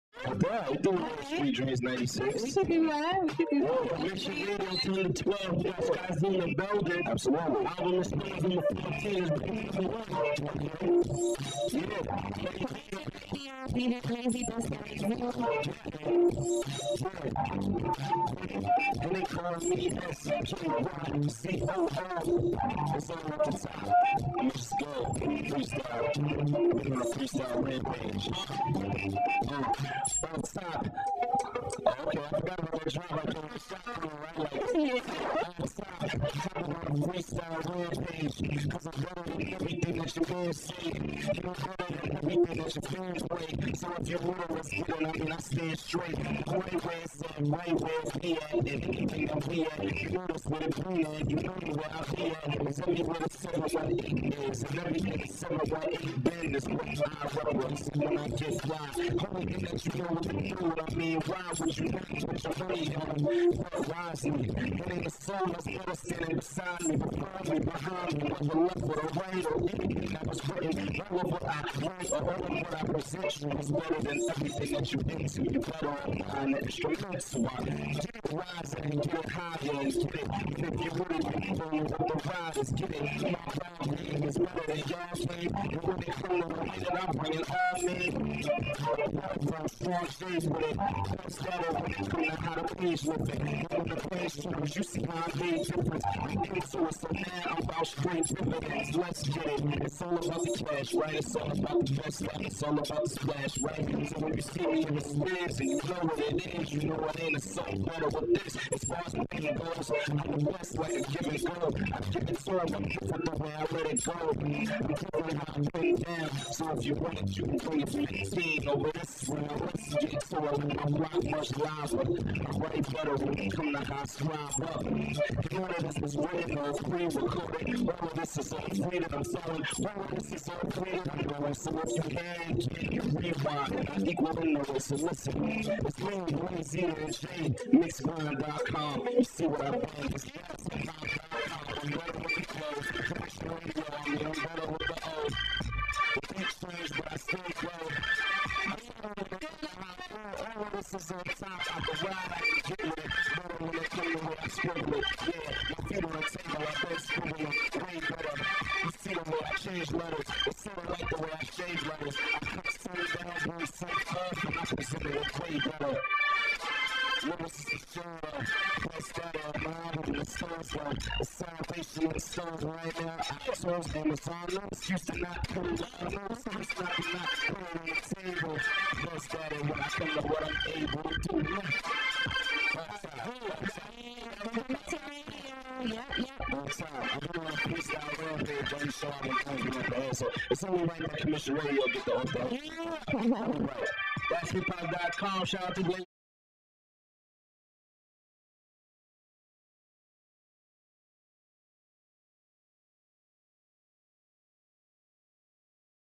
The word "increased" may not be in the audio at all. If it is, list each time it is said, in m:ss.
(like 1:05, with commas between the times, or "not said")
not said.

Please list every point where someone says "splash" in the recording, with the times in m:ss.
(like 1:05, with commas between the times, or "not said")
1:43.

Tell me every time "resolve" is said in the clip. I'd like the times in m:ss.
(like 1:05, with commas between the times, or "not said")
not said.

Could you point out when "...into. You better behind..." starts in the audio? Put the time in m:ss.
1:15.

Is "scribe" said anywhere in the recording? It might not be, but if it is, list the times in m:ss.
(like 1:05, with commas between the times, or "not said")
2:04.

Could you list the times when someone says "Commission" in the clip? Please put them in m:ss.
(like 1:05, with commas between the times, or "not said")
3:11.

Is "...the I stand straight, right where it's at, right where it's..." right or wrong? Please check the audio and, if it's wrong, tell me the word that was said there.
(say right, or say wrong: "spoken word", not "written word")
right.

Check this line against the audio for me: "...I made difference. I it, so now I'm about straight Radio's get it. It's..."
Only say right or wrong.
wrong.